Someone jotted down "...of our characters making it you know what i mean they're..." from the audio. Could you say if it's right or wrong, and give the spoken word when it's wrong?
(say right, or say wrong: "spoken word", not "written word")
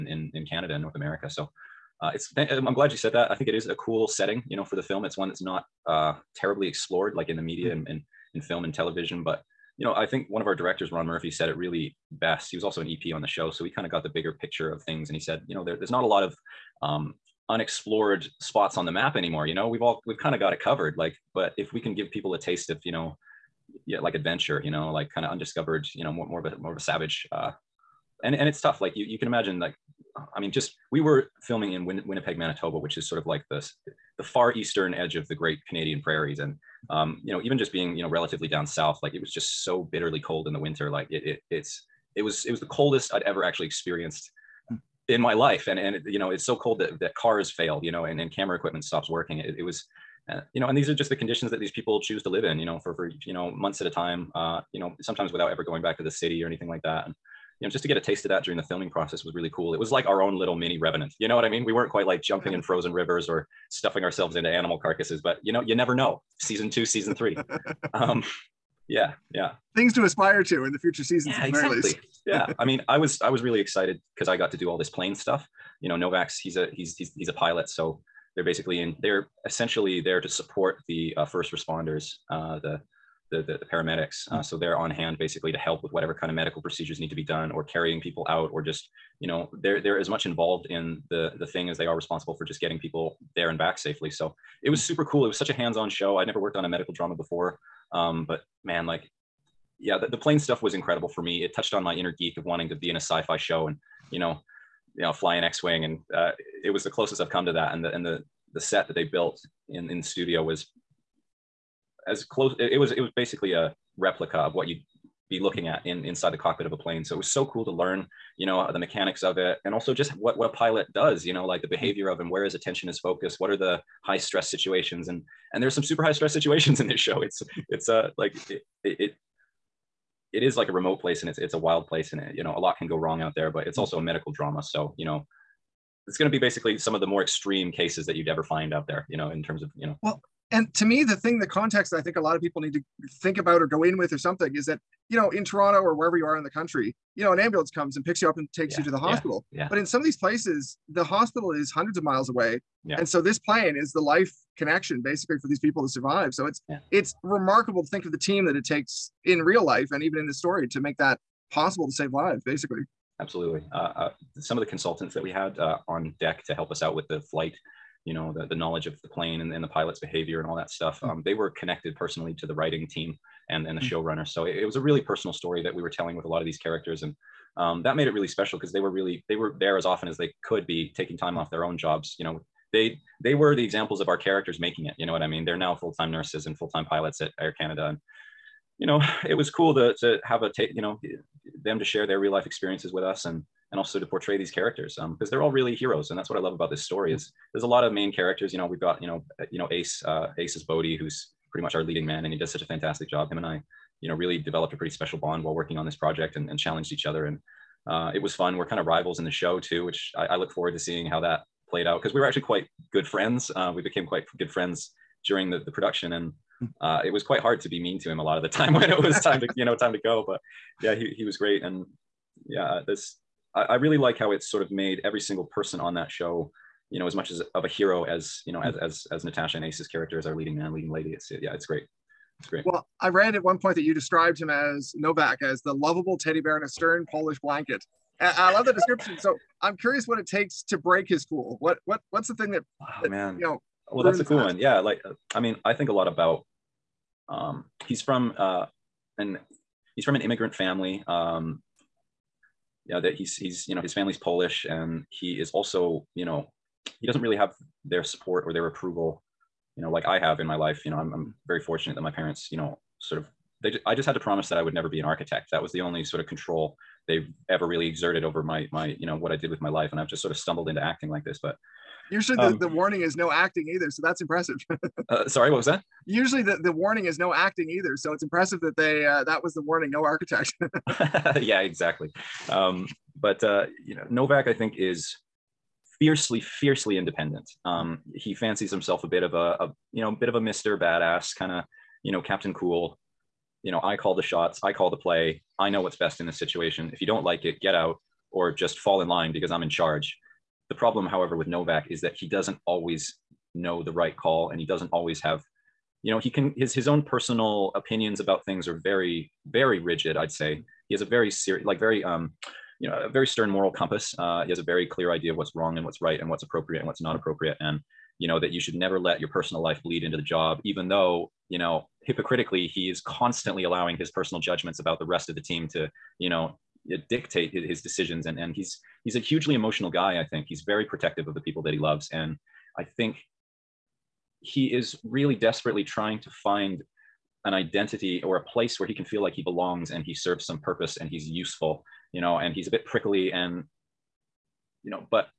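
right.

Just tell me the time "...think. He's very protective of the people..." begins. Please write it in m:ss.
5:30.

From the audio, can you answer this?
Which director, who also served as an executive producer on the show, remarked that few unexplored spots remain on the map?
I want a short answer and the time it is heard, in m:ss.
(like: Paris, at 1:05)
Ron Murphy, at 0:10.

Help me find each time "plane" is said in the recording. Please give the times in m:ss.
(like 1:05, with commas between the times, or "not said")
1:14, 1:40, 1:56, 2:33, 2:49.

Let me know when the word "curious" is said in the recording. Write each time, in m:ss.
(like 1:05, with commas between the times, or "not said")
3:59.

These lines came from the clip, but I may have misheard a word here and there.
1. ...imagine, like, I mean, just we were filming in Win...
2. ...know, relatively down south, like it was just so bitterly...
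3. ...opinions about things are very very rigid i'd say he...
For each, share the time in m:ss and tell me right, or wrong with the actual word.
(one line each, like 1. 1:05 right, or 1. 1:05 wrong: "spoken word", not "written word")
1. 0:29 right
2. 0:38 right
3. 5:07 right.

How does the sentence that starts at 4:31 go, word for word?
But usually the, um, the warning is no acting either, so that's impressive.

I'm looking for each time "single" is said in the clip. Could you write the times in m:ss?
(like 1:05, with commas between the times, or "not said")
3:45.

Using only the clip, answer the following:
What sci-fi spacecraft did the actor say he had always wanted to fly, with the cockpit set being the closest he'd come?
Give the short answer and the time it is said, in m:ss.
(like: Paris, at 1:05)
X-wing, at 1:45.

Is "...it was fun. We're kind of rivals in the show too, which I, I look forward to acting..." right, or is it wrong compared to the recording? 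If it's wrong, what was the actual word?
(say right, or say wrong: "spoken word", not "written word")
wrong: "seeing", not "acting".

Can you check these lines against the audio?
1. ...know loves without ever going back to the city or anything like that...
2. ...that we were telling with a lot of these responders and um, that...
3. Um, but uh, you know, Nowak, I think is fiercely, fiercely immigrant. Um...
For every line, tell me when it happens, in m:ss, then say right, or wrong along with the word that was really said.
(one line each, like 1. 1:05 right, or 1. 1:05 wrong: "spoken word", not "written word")
1. 0:54 wrong: "sometimes", not "loves"
2. 2:55 wrong: "characters", not "responders"
3. 4:42 wrong: "independent", not "immigrant".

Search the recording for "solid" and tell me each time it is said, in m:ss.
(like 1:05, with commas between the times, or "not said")
not said.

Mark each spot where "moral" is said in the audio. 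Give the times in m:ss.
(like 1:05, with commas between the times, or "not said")
5:13.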